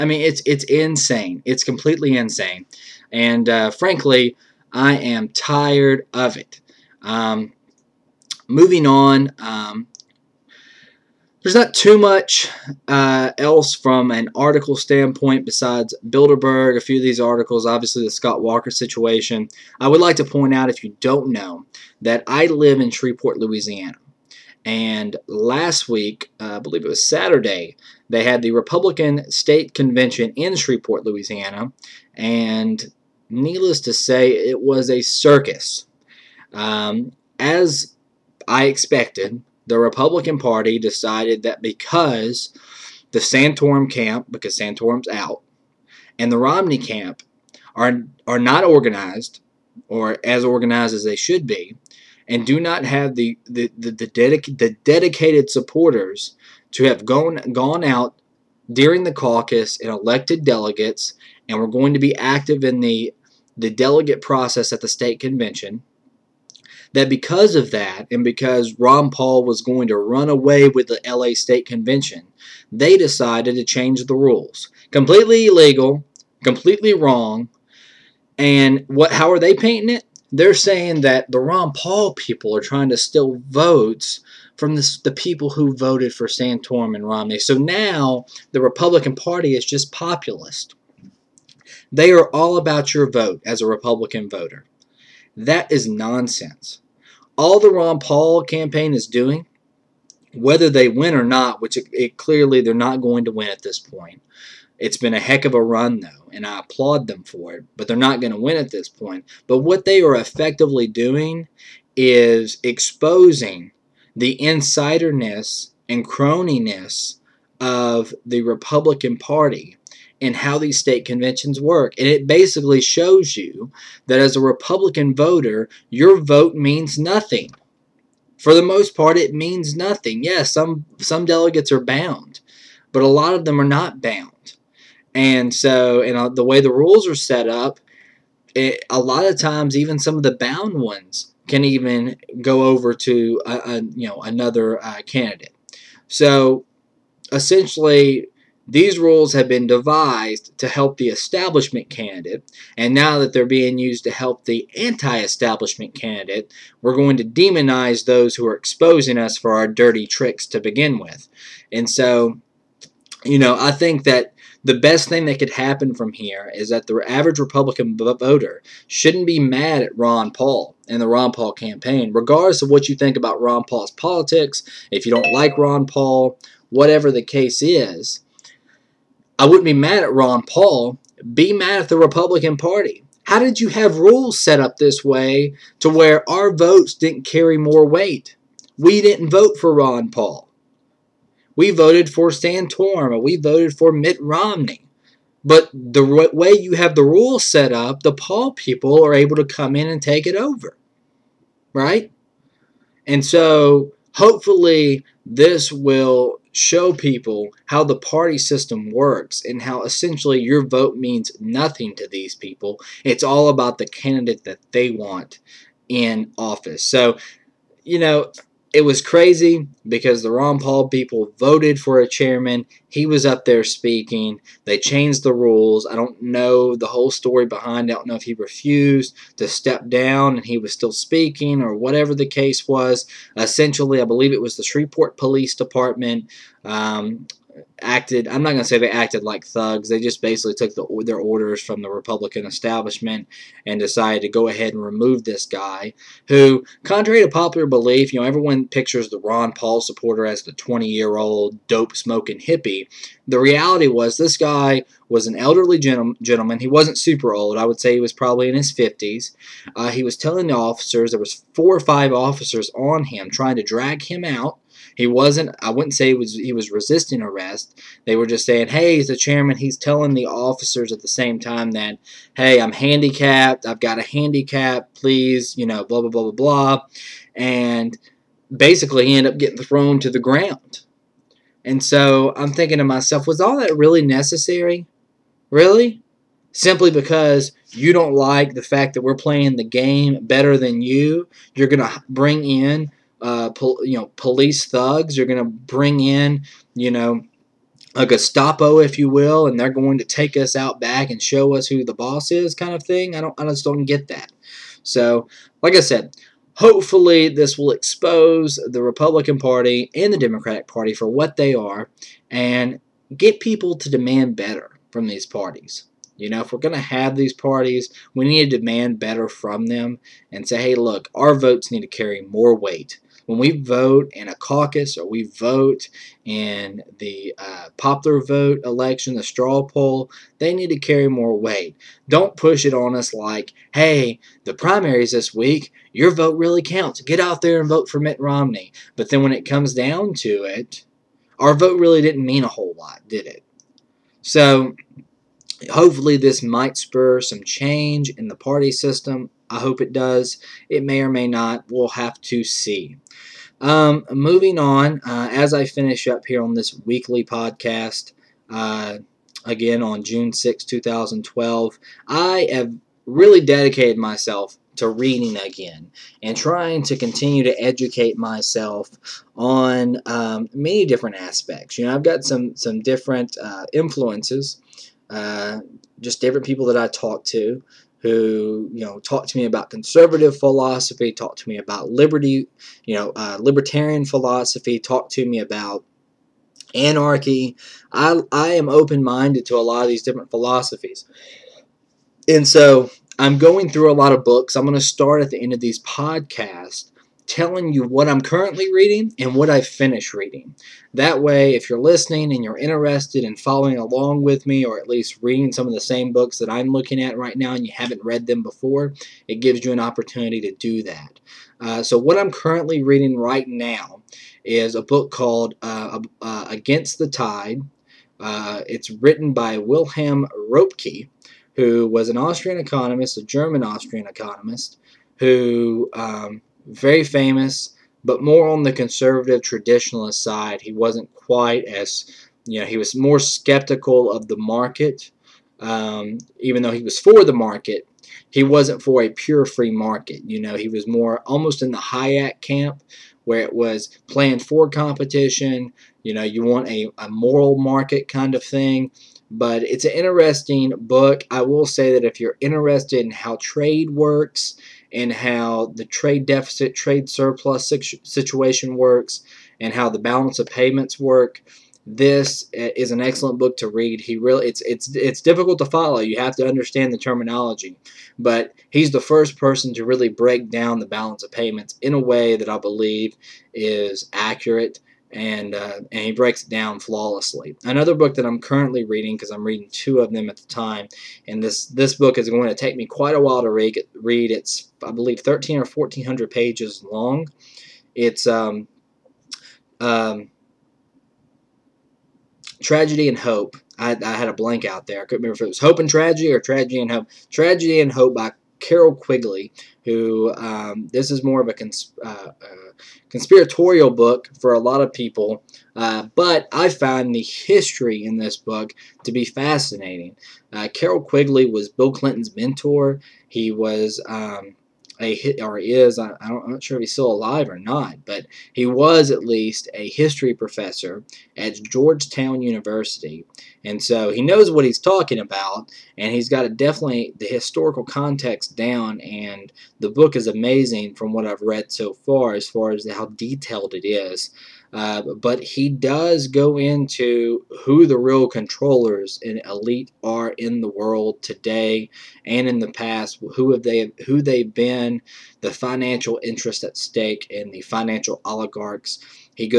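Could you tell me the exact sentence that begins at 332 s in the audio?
Don't push it on us like, hey, the primaries this week, your vote really counts.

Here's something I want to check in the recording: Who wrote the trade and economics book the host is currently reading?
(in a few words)
Wilhelm Röpke.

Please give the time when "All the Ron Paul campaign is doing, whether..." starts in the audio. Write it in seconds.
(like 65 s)
97 s.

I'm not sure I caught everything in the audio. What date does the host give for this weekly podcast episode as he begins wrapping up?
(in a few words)
June 6, 2012.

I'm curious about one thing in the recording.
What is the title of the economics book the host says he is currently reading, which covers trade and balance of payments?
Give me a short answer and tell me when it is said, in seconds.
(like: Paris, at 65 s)
Against the Tide, at 416 s.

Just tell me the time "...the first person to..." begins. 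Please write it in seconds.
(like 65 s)
468 s.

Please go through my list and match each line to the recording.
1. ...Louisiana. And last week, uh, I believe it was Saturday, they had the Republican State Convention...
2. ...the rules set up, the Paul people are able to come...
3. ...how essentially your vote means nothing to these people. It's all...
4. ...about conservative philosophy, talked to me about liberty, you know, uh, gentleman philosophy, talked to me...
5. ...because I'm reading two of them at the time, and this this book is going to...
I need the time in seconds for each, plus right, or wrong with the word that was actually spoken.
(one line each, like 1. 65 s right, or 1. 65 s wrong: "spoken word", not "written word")
1. 23 s right
2. 196 s right
3. 209 s right
4. 379 s wrong: "libertarian", not "gentleman"
5. 479 s right.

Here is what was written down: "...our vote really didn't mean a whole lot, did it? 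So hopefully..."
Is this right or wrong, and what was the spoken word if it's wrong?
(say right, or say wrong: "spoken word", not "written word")
right.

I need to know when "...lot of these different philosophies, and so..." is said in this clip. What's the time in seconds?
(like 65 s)
389 s.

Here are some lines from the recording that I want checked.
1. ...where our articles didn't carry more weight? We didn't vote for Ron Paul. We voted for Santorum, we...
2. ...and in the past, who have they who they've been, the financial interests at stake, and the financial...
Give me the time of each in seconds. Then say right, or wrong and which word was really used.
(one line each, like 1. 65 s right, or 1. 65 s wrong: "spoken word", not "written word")
1. 185 s wrong: "votes", not "articles"
2. 542 s right.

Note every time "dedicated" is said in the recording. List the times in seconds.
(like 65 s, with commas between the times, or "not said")
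54 s, 363 s.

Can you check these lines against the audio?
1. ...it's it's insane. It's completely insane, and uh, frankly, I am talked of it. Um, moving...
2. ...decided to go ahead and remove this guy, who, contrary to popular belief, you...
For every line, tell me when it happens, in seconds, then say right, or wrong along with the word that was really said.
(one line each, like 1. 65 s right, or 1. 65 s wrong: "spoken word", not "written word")
1. 0 s wrong: "tired", not "talked"
2. 243 s right.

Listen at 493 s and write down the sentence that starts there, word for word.
I, I had a blank out there.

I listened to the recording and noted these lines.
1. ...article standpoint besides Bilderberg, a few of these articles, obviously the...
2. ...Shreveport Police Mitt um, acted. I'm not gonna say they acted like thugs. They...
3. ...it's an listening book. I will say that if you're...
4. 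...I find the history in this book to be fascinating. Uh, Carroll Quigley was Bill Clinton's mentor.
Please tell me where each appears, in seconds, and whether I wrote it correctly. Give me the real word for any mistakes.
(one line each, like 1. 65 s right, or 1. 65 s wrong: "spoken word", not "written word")
1. 14 s right
2. 234 s wrong: "Department", not "Mitt"
3. 449 s wrong: "interesting", not "listening"
4. 506 s right.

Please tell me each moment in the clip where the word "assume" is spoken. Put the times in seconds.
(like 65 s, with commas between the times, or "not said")
not said.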